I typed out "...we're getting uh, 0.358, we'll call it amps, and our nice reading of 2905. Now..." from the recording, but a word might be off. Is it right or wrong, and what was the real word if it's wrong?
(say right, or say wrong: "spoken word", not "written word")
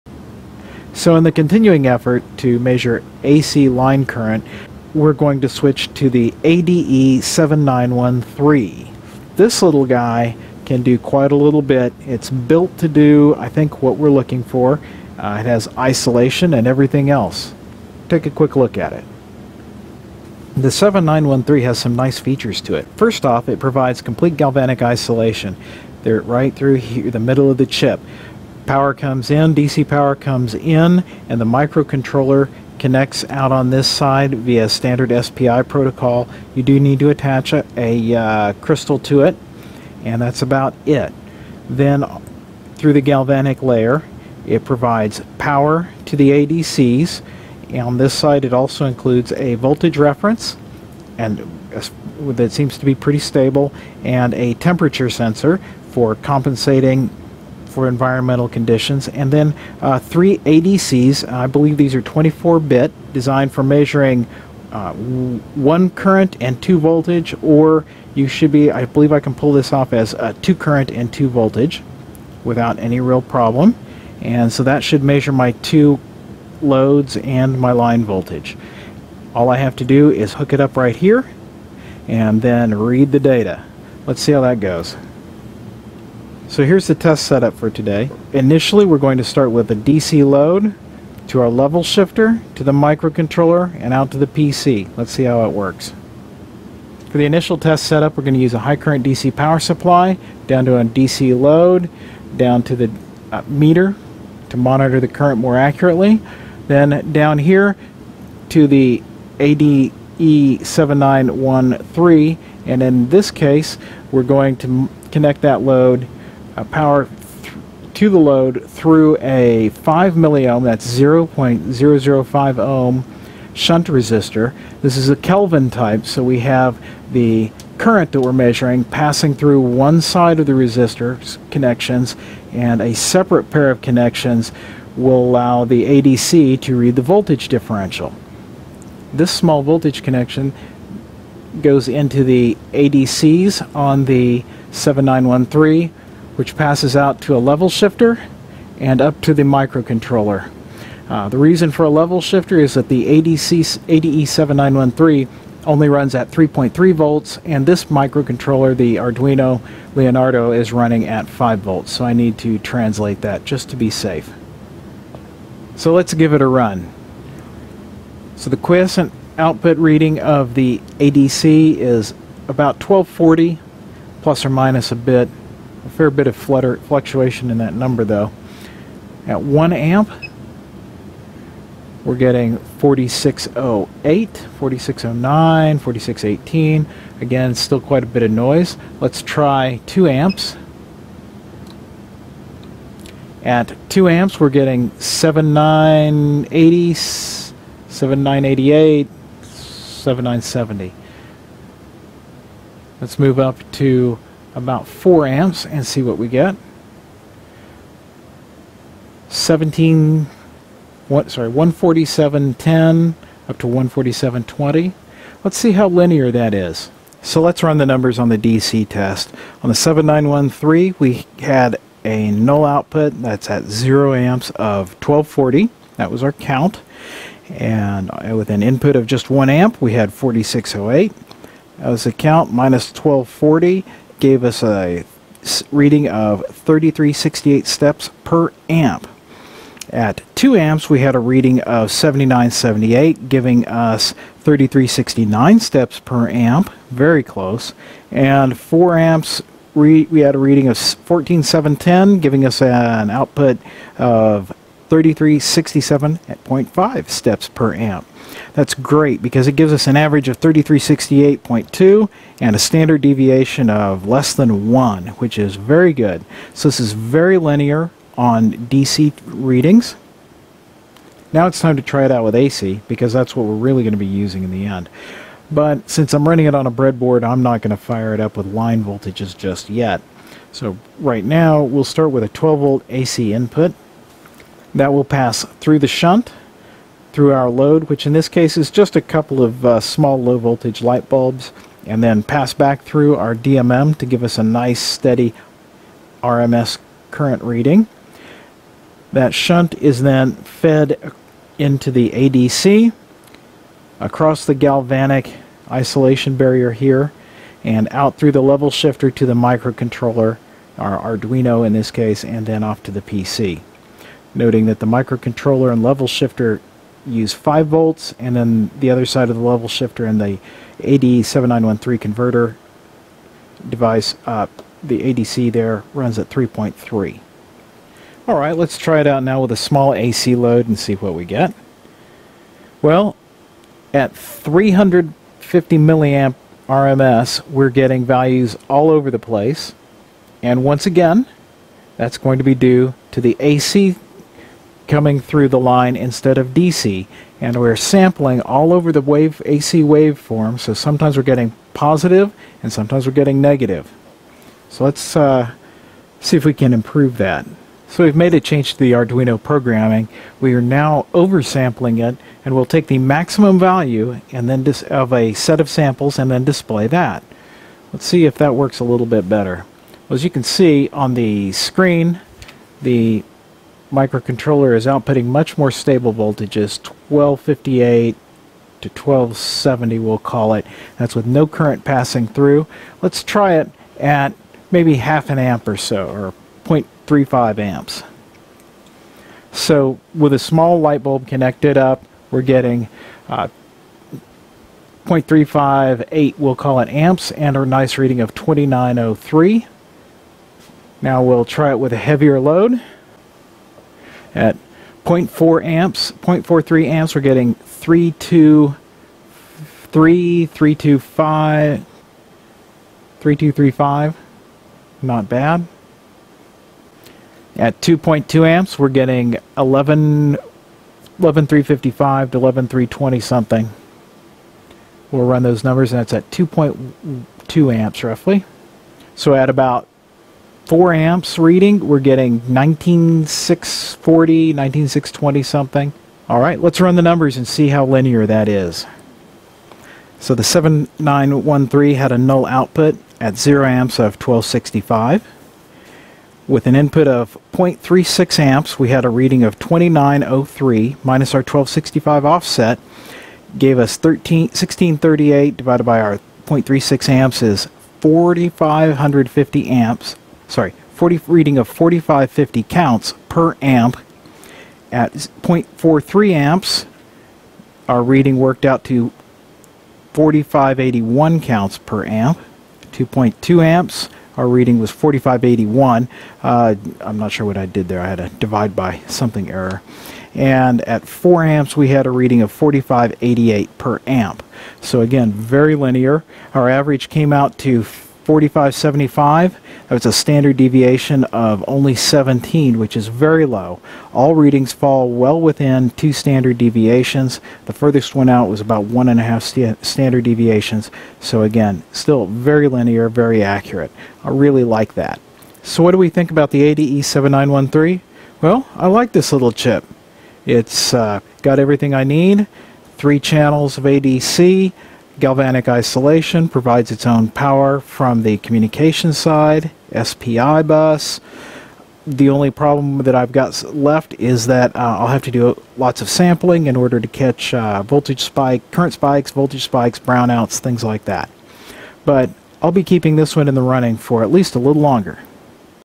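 wrong: "2903", not "2905".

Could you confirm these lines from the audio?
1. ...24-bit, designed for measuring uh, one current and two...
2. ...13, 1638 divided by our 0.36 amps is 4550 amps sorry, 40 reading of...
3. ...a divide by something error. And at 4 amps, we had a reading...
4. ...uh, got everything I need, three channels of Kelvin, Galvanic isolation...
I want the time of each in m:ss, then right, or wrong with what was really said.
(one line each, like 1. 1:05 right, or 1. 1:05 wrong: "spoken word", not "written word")
1. 1:02 right
2. 7:33 right
3. 7:58 right
4. 8:30 wrong: "ADC", not "Kelvin".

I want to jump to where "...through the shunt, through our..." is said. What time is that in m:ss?
4:45.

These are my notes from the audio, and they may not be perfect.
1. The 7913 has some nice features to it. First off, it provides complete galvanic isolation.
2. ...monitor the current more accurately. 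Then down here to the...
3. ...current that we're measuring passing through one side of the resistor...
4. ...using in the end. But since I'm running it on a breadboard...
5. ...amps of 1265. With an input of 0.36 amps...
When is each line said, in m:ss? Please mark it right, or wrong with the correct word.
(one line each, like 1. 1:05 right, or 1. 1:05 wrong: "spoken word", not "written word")
1. 0:20 right
2. 1:44 right
3. 2:07 right
4. 4:34 right
5. 7:23 right.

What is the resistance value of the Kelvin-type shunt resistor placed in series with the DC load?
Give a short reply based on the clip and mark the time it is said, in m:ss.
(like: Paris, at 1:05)
5 milliohm, at 1:59.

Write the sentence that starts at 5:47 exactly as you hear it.
And we're sampling all over the wave AC waveform, so sometimes we're getting positive and sometimes we're getting negative.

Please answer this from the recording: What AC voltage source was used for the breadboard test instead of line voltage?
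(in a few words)
12 volt.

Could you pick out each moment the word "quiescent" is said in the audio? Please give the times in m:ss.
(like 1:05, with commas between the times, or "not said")
2:48.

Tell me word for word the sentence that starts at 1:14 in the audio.
And so that should measure my two loads and my line voltage.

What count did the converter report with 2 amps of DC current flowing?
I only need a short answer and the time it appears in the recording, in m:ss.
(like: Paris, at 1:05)
7978, at 4:01.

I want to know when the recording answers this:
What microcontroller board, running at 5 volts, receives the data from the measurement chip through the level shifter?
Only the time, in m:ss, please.
2:38.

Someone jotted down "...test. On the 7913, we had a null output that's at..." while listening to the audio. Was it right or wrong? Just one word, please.
right.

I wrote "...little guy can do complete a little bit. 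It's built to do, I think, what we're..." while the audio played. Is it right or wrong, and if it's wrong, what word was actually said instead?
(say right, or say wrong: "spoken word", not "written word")
wrong: "quite", not "complete".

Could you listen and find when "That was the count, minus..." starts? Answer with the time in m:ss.
3:51.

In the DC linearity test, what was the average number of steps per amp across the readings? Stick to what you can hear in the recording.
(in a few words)
3368.2.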